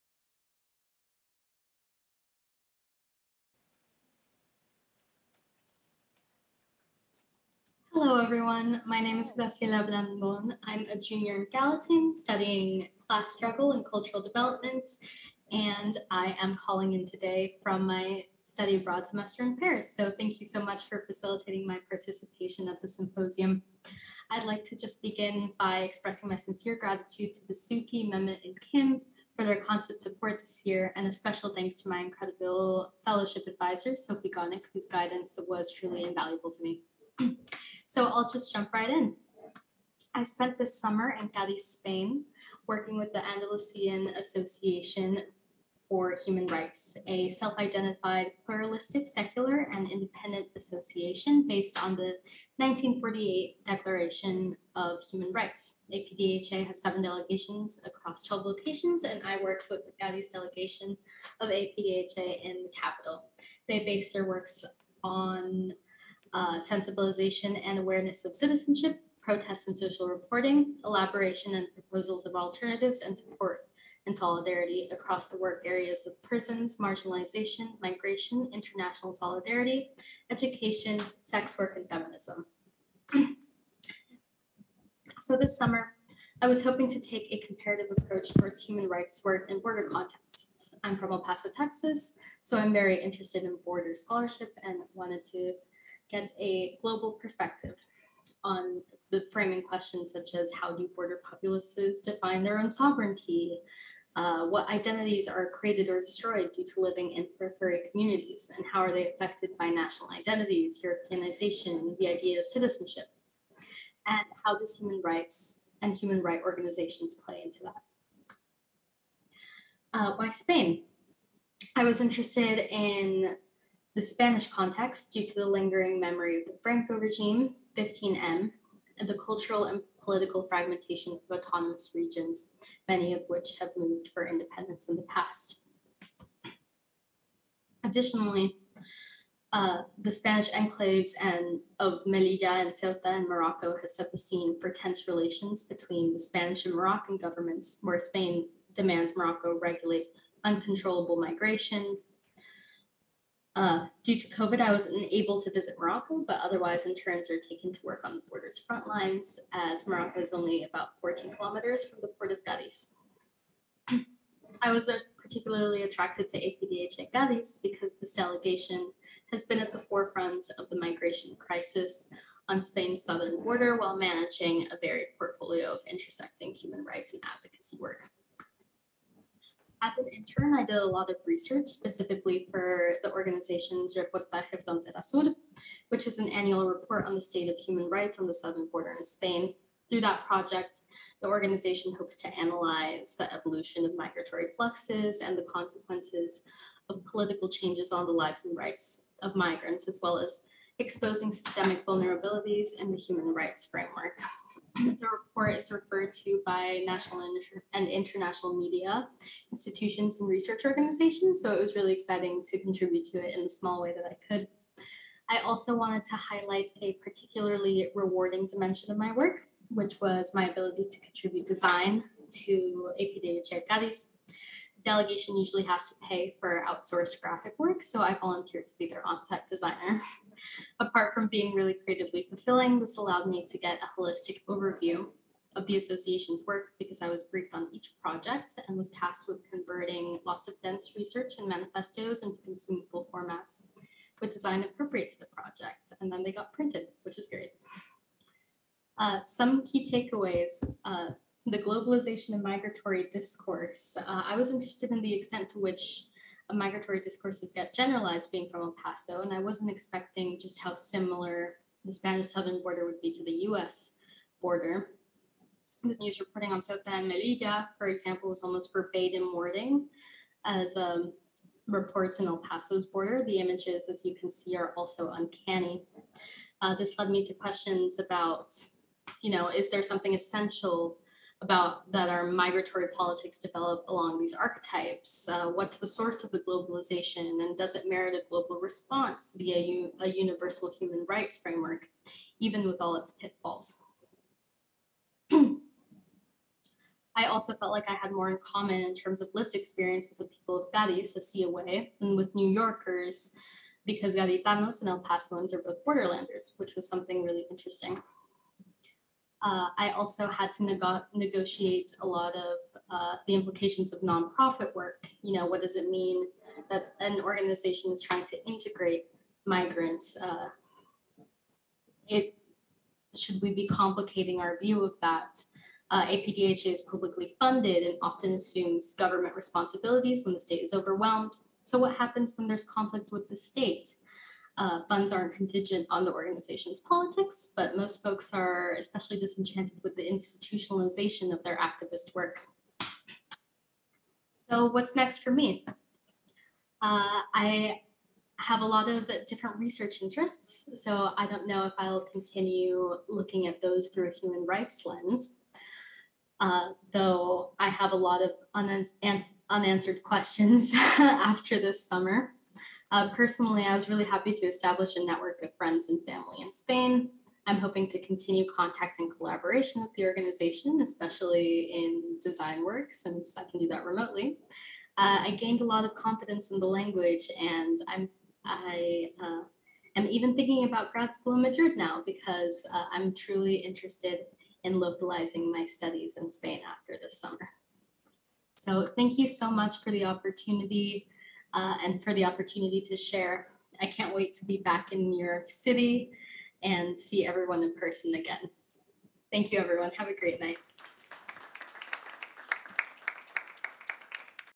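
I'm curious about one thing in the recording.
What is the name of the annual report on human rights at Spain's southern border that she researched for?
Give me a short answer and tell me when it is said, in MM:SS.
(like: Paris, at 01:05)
Reportaje Frontera Sur, at 03:03.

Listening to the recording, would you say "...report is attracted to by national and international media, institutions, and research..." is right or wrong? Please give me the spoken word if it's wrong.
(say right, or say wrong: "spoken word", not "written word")
wrong: "referred", not "attracted".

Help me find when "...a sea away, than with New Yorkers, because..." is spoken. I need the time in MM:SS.
05:01.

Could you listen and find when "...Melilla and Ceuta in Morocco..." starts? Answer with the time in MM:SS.
02:22.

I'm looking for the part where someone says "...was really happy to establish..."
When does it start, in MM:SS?
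06:03.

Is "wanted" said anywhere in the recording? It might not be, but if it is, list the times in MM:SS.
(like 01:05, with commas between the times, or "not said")
01:34, 03:35.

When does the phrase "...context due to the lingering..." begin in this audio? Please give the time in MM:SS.
02:04.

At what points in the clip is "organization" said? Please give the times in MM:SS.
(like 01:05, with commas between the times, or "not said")
01:56, 03:03, 03:11, 03:30, 05:17, 05:36, 06:10.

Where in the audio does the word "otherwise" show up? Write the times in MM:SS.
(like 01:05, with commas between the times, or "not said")
02:36.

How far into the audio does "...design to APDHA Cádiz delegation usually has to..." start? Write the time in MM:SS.
03:41.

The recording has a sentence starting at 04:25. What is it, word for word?
The news reporting on Ceuta and Melilla, for example, was almost verbatim wording as um, reports in El Paso's border.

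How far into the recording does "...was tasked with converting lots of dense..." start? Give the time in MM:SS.
03:58.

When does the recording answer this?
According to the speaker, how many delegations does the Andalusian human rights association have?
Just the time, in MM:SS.
00:56.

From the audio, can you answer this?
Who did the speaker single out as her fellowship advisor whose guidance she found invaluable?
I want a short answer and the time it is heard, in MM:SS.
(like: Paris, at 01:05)
Sophie Gonick, at 00:33.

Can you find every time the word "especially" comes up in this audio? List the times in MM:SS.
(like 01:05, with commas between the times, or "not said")
05:38, 06:10.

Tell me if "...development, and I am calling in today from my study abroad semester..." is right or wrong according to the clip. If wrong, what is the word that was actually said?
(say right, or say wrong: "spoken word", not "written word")
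right.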